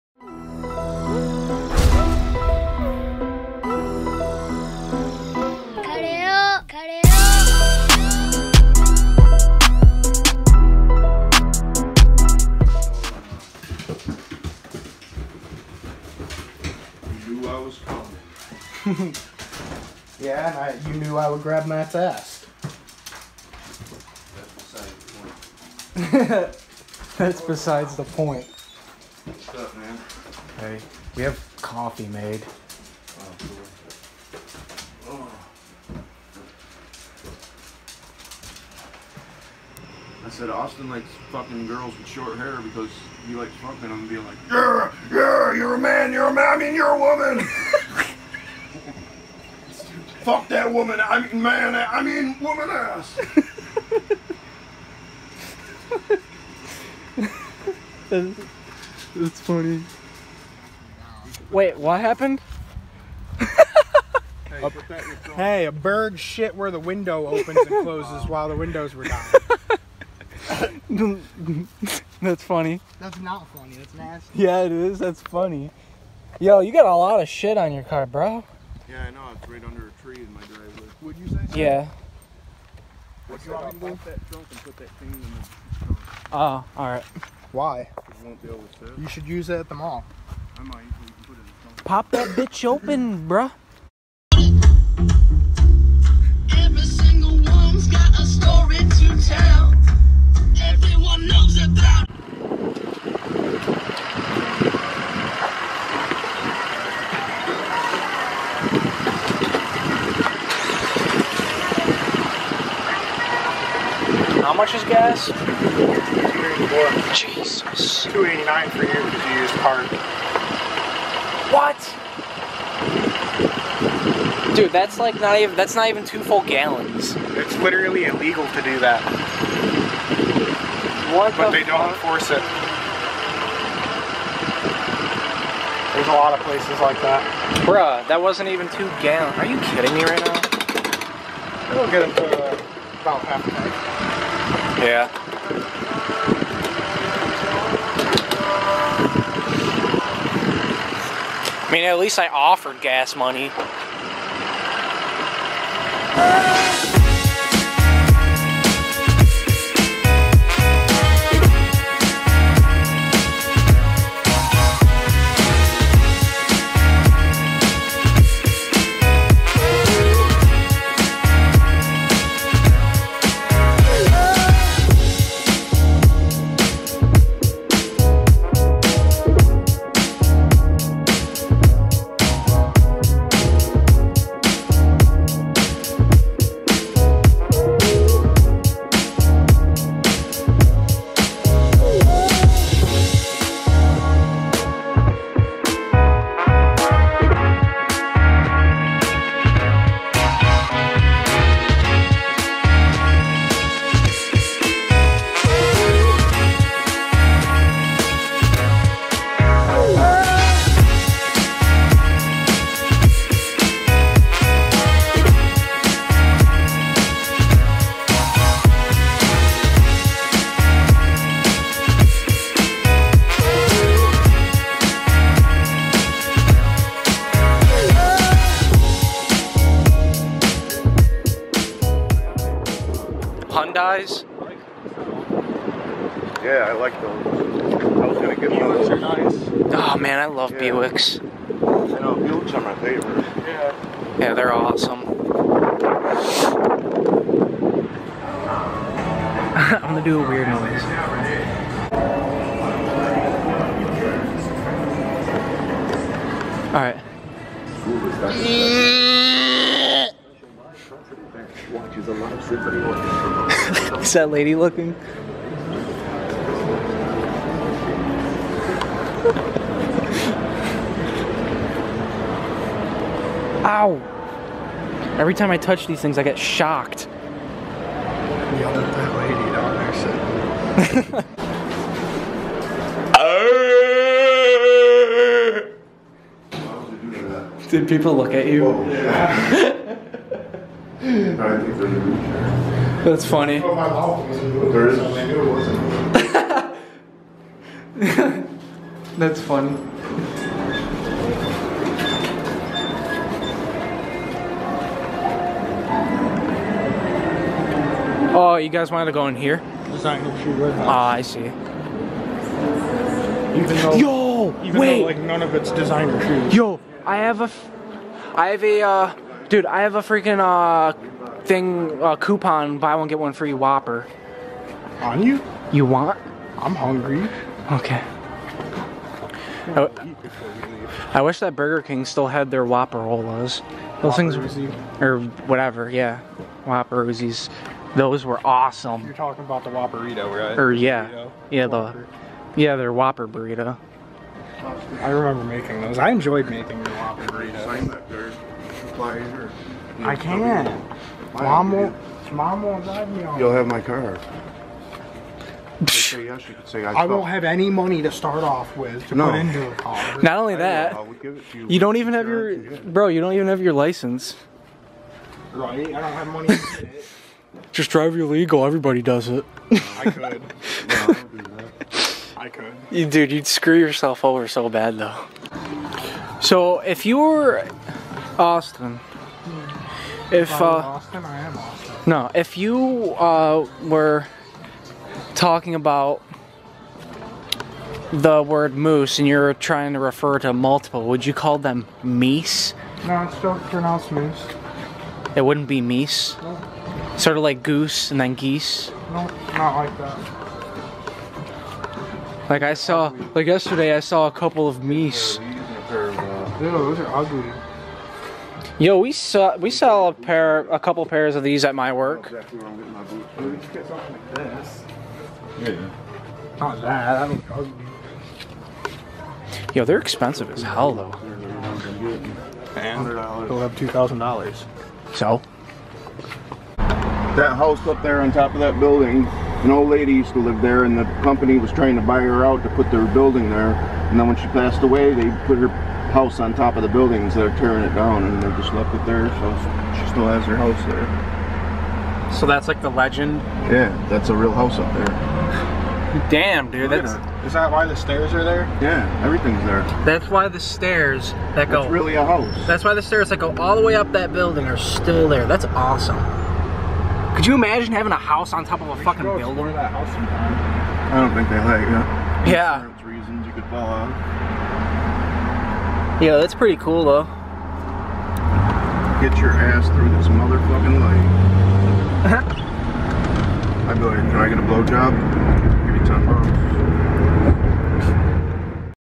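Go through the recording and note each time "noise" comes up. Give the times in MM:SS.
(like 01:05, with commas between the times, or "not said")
04:10.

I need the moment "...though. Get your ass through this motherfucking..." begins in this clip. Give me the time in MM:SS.
07:47.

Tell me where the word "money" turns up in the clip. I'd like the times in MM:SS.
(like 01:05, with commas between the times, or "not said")
02:33, 05:57, 06:06.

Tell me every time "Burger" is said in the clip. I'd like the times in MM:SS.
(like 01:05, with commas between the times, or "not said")
05:31.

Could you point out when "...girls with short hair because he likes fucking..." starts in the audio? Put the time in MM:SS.
00:41.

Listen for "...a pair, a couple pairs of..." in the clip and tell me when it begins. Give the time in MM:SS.
06:50.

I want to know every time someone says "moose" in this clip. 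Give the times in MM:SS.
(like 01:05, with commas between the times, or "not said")
06:28, 06:34.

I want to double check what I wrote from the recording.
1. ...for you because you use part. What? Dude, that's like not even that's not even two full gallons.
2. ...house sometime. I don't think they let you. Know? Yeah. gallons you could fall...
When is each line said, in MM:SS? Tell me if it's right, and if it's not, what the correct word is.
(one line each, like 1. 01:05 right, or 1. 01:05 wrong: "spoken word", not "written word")
1. 01:58 right
2. 07:39 wrong: "reasons", not "gallons".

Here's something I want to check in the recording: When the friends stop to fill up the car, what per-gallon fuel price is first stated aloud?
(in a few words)
2.84.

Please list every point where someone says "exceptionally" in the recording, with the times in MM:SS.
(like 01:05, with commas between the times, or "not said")
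not said.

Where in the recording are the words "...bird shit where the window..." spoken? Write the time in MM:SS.
01:05.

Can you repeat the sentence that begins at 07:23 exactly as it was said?
Yeah, that's a real house up there.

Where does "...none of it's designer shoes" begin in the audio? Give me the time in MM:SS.
05:15.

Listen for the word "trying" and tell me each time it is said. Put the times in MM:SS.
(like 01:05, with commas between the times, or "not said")
06:29, 07:11.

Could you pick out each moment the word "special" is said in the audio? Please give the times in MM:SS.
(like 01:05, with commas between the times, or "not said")
not said.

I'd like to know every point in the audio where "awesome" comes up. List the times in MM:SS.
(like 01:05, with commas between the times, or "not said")
04:04, 05:38, 07:35.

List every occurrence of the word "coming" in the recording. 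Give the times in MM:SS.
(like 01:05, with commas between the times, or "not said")
00:17.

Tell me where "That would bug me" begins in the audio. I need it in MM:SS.
06:57.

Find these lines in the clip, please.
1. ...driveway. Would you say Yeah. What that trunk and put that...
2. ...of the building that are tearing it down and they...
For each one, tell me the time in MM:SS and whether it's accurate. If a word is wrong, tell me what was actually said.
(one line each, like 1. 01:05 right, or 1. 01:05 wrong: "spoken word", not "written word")
1. 01:20 right
2. 07:16 right.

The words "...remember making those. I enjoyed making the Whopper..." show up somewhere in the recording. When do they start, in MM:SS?
05:45.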